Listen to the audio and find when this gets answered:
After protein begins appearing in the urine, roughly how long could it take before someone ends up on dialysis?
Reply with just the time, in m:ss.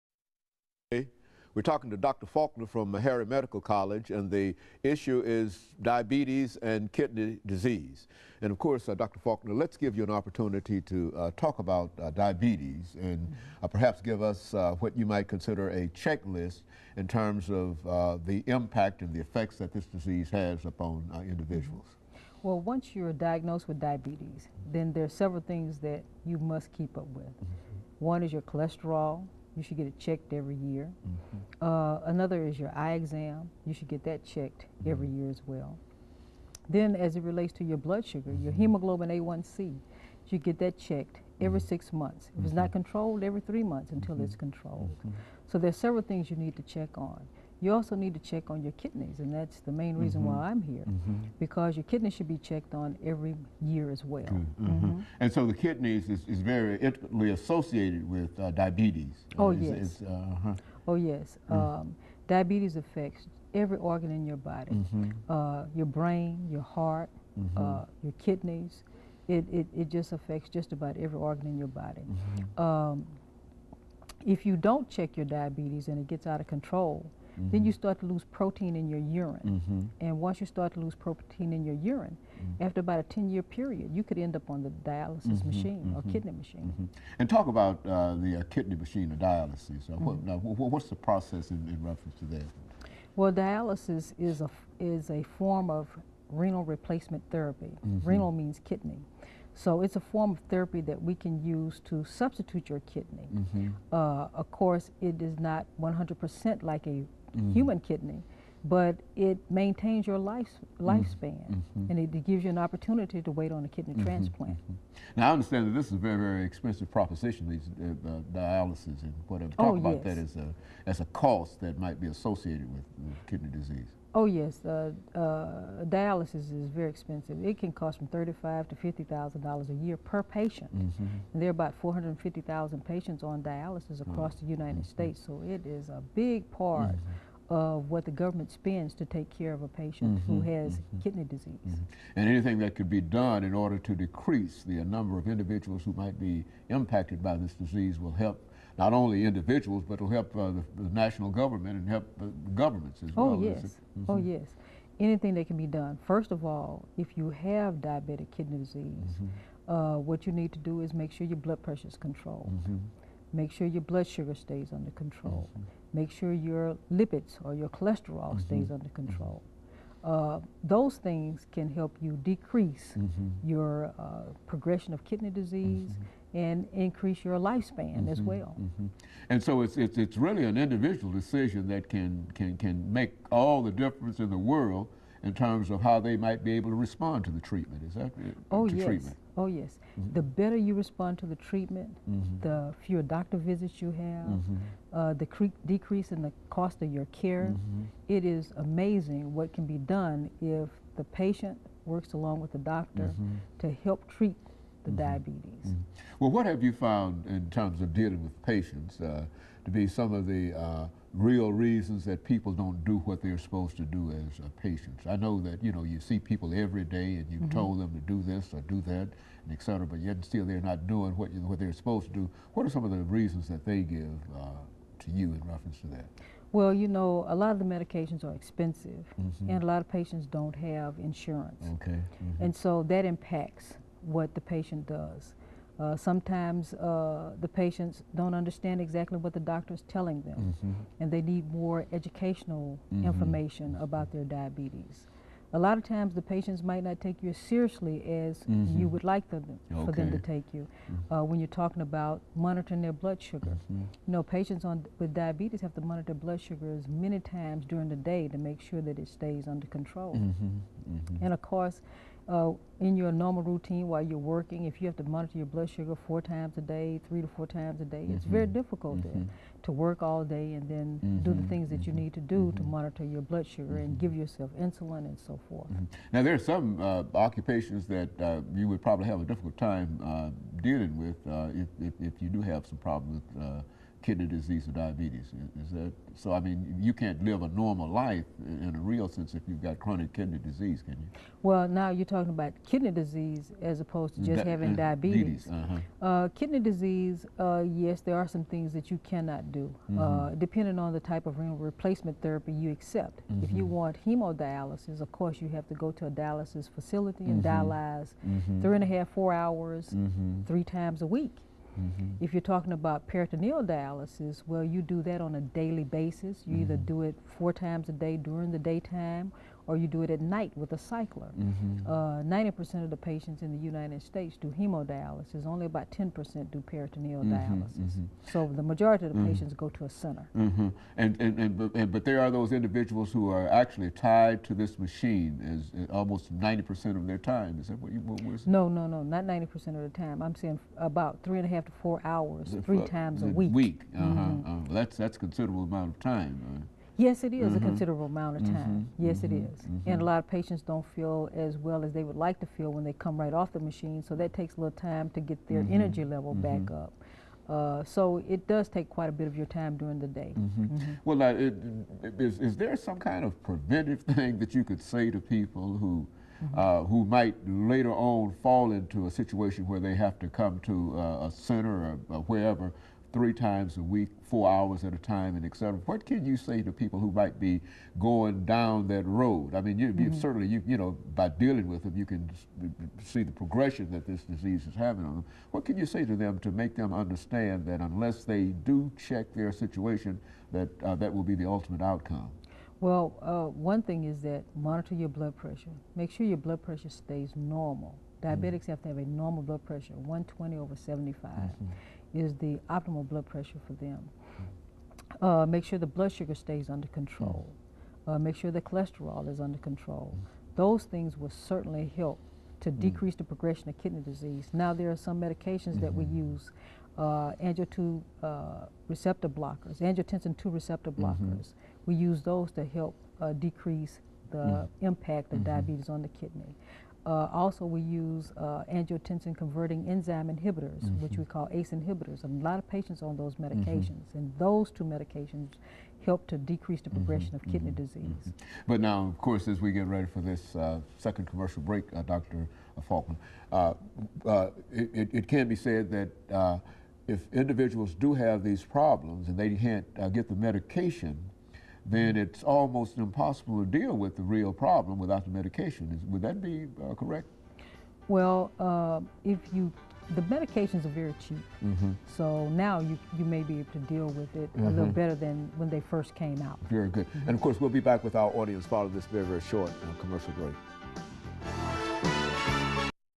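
1:23.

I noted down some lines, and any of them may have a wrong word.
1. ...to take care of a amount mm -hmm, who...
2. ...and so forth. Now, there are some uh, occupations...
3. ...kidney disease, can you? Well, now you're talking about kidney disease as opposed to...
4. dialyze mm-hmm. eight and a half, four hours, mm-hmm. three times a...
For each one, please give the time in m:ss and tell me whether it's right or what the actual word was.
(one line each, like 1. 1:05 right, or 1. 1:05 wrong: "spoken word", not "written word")
1. 2:18 wrong: "patient", not "amount"
2. 4:35 right
3. 4:50 right
4. 5:07 wrong: "three", not "eight".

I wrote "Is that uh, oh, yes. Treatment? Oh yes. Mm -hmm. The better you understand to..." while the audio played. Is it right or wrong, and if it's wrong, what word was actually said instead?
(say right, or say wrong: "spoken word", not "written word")
wrong: "respond", not "understand".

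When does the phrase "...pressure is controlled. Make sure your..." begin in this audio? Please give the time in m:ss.
2:41.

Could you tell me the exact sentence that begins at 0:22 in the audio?
Well, once you're diagnosed with diabetes, then there are several things that you must keep up with.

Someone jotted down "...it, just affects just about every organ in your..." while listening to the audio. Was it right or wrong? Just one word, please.
right.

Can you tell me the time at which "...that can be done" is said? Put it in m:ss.
2:35.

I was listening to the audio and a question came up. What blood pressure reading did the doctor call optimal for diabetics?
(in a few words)
120/75.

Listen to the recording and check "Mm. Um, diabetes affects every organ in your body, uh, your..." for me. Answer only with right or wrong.
right.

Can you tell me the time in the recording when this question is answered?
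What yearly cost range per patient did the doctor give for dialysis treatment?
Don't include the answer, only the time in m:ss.
2:08.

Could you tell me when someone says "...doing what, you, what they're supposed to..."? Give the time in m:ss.
3:40.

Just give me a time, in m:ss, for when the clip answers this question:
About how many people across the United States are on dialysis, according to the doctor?
2:11.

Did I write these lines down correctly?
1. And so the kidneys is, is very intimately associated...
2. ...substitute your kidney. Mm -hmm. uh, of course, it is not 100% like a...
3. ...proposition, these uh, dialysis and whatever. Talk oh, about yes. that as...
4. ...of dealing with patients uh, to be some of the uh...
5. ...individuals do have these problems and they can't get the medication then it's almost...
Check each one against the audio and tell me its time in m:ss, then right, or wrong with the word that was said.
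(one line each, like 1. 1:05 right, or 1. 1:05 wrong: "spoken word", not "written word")
1. 0:55 right
2. 1:42 right
3. 1:56 right
4. 3:27 right
5. 7:27 right.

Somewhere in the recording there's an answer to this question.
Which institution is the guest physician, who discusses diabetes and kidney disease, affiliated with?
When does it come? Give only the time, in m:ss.
0:02.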